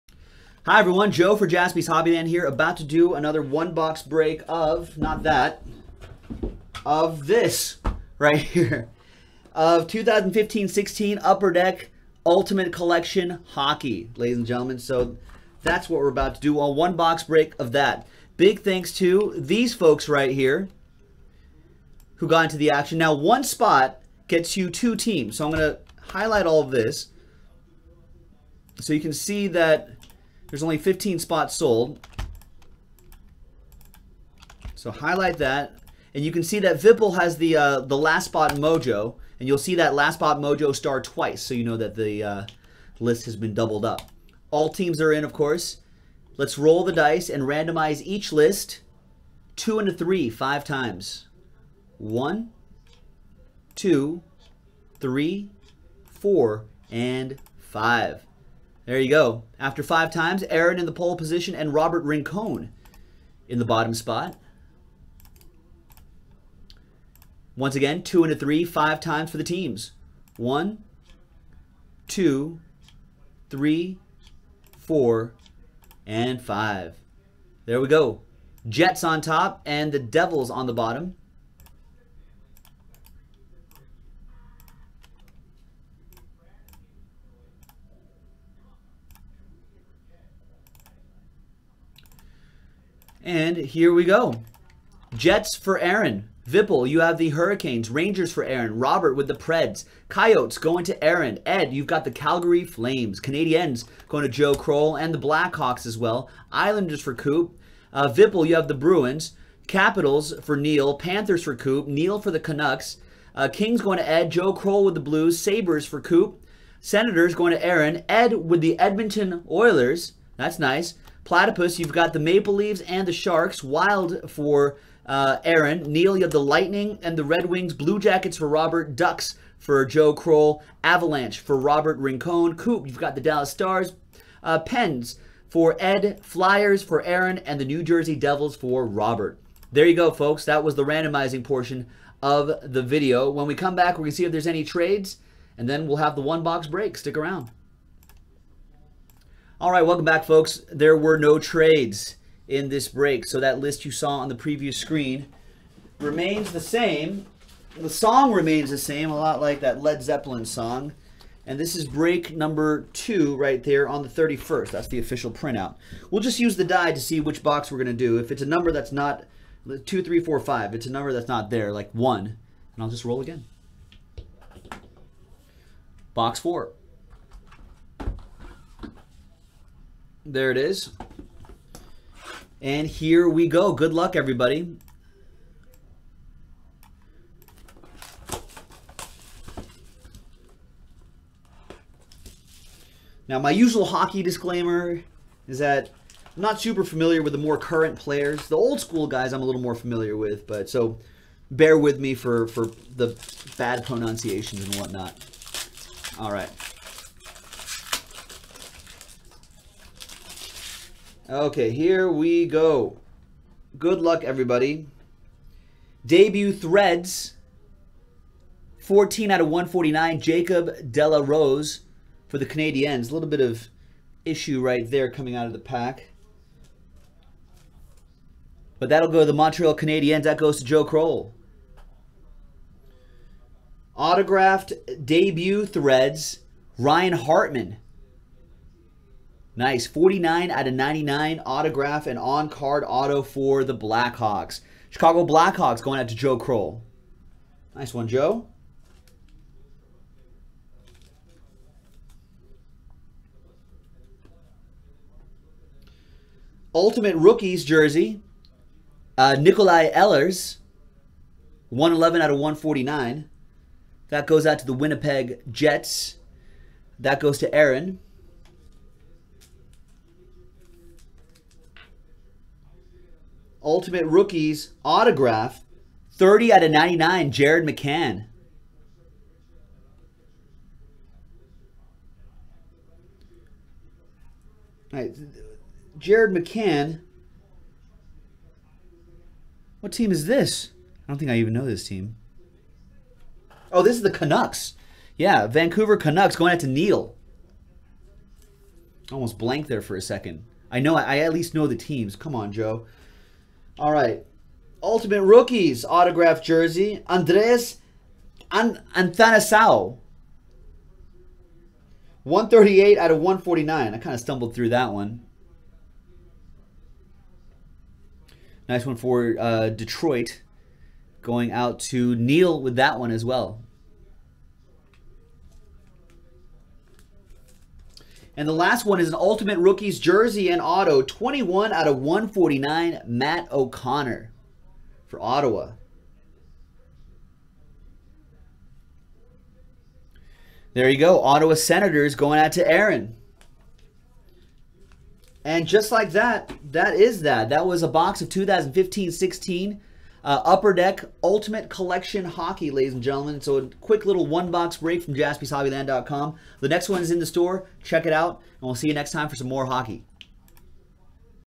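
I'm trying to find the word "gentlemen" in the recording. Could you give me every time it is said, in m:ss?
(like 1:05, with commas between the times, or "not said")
0:14, 5:53.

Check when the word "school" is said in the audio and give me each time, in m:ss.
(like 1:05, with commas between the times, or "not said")
3:18.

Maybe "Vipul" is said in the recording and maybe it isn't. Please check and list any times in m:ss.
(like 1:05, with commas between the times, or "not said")
0:36, 1:36, 1:48.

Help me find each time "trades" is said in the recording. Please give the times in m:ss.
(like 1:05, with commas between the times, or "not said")
2:24, 2:31.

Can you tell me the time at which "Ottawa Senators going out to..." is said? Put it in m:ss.
5:41.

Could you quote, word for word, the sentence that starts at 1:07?
Once again, two and a three, five times for the teams.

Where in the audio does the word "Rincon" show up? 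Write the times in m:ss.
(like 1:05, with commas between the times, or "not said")
1:02, 2:11.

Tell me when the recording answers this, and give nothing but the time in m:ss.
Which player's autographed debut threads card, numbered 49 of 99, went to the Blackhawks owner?
3:56.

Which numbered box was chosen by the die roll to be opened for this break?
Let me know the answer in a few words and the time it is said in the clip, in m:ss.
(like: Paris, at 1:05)
Box 4, at 2:56.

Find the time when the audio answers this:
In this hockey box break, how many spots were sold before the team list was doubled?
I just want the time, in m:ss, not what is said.
0:30.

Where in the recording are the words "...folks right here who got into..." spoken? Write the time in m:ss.
0:19.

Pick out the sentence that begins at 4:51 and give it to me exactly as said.
I don't think I even know this team.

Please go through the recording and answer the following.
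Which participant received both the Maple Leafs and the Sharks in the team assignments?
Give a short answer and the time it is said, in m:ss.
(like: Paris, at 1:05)
Platypus, at 2:01.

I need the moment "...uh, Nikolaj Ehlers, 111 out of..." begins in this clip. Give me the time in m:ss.
4:19.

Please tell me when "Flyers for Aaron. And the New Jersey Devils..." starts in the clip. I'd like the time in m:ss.
2:16.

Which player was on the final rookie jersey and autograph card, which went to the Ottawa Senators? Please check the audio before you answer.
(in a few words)
Matt O'Connor.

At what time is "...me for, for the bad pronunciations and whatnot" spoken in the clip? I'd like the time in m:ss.
3:21.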